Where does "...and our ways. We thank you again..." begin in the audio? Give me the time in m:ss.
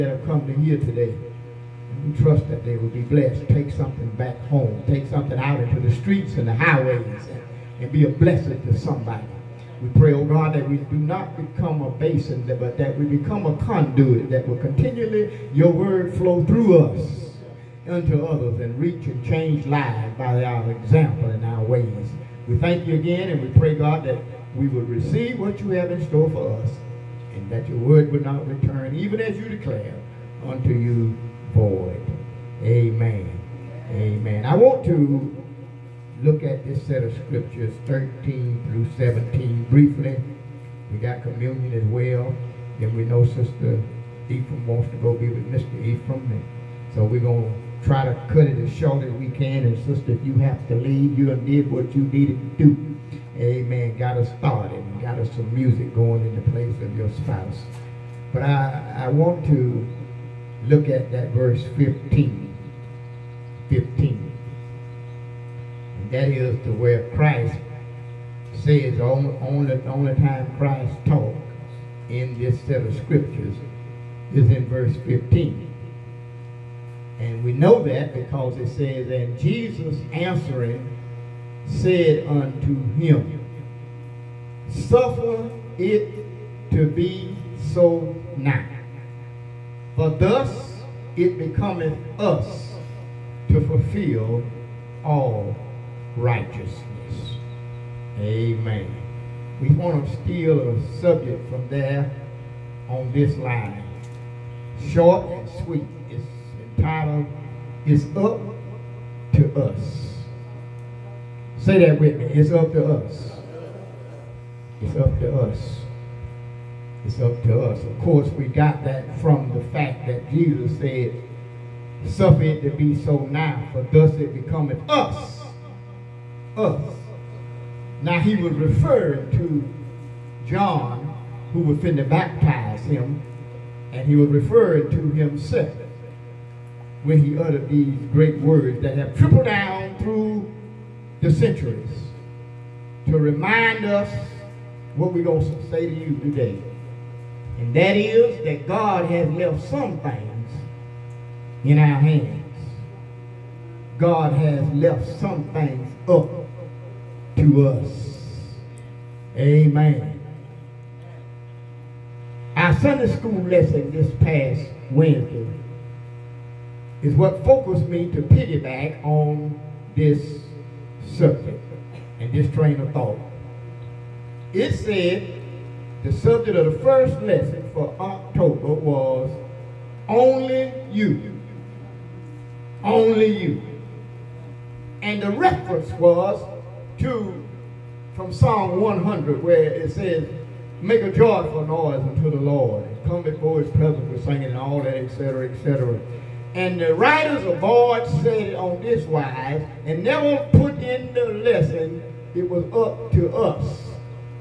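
0:21.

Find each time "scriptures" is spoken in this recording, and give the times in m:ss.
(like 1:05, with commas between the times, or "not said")
0:37, 1:12.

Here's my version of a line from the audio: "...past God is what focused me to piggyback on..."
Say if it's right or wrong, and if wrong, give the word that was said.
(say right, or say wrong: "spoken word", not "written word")
wrong: "Wednesday", not "God".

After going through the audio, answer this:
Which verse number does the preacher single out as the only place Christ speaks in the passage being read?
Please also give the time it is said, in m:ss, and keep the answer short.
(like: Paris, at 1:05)
15, at 1:01.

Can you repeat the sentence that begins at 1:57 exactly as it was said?
Of course, we got that from the fact that Jesus said, Suffer it to be so now, for thus it becometh us.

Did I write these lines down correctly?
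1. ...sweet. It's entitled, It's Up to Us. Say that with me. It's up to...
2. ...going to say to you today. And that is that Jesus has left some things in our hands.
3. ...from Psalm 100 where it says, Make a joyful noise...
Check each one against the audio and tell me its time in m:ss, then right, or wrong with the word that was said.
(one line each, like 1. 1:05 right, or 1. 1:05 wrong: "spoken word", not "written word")
1. 1:45 right
2. 2:25 wrong: "God", not "Jesus"
3. 3:08 right.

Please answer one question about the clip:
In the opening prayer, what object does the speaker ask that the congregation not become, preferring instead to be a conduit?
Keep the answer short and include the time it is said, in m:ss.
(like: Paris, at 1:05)
a basin, at 0:11.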